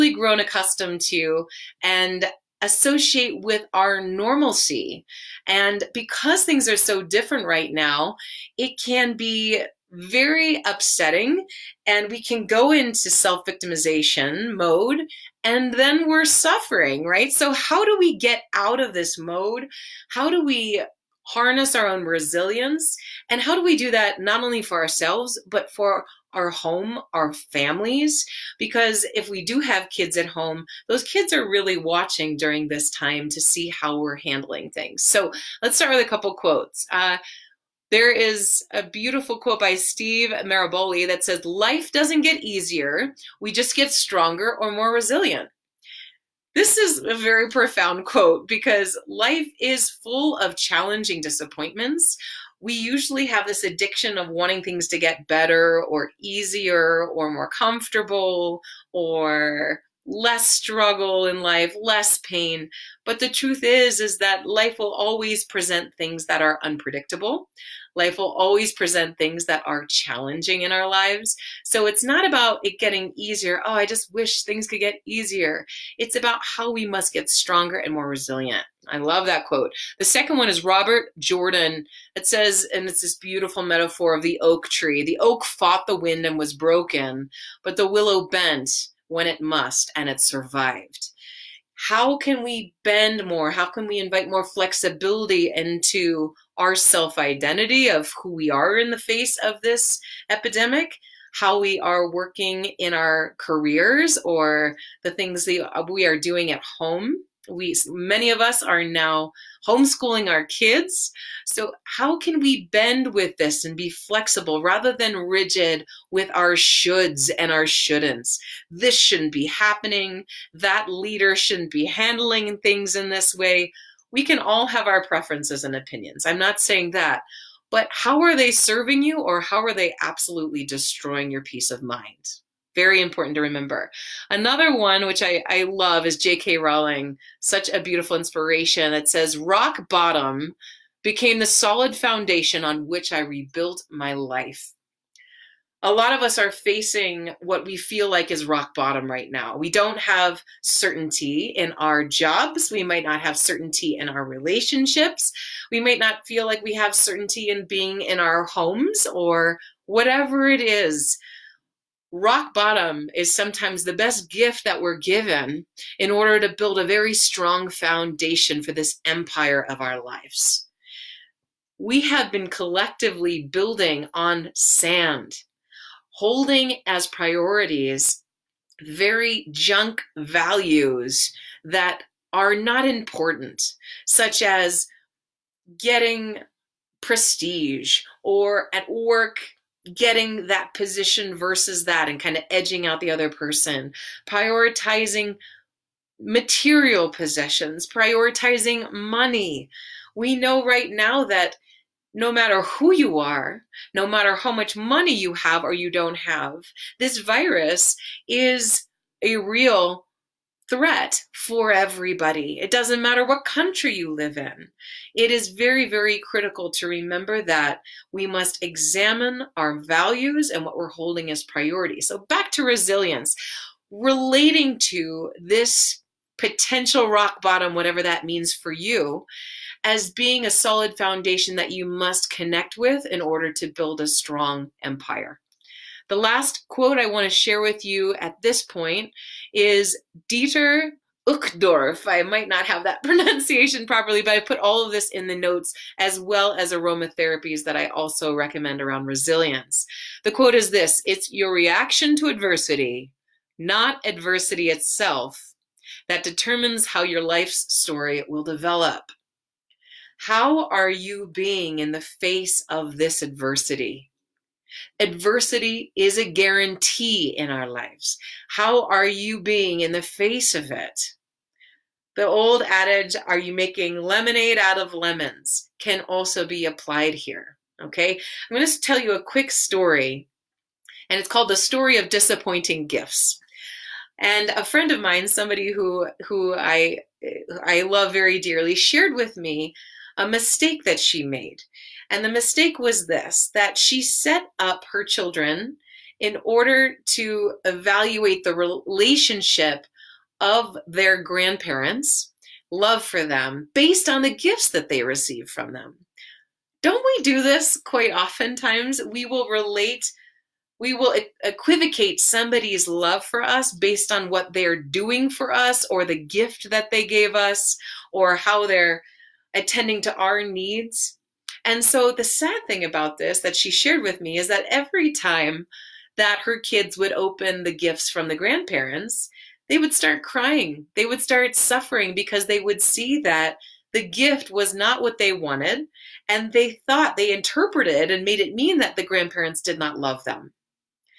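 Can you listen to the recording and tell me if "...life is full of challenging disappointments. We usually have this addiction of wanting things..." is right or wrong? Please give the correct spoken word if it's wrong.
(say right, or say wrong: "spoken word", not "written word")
right.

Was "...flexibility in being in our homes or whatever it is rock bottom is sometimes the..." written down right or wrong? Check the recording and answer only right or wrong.
wrong.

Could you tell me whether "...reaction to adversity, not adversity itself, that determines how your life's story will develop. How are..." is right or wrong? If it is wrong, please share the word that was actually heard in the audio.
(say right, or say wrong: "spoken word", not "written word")
right.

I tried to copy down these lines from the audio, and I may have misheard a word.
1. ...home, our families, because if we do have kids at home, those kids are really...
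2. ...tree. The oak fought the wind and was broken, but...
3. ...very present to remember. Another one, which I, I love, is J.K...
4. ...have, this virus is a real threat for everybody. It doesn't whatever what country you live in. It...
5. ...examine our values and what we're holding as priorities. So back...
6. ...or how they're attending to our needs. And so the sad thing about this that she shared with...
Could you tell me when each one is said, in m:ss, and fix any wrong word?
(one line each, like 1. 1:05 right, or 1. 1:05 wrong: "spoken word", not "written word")
1. 0:26 right
2. 1:24 right
3. 2:12 wrong: "important", not "present"
4. 3:26 wrong: "matter", not "whatever"
5. 3:38 right
6. 5:18 right.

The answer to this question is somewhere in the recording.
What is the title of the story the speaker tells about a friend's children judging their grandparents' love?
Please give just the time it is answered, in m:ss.
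4:41.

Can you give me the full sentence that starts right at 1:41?
How we are working in our careers or the things that we are doing at home?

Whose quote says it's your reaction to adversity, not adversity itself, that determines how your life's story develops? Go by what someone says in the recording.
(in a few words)
Dieter Uchtdorf.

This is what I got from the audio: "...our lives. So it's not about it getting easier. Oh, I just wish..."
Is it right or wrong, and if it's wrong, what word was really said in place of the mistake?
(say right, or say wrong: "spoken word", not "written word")
right.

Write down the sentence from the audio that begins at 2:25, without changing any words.
A lot of us are facing what we feel like is rock bottom right now.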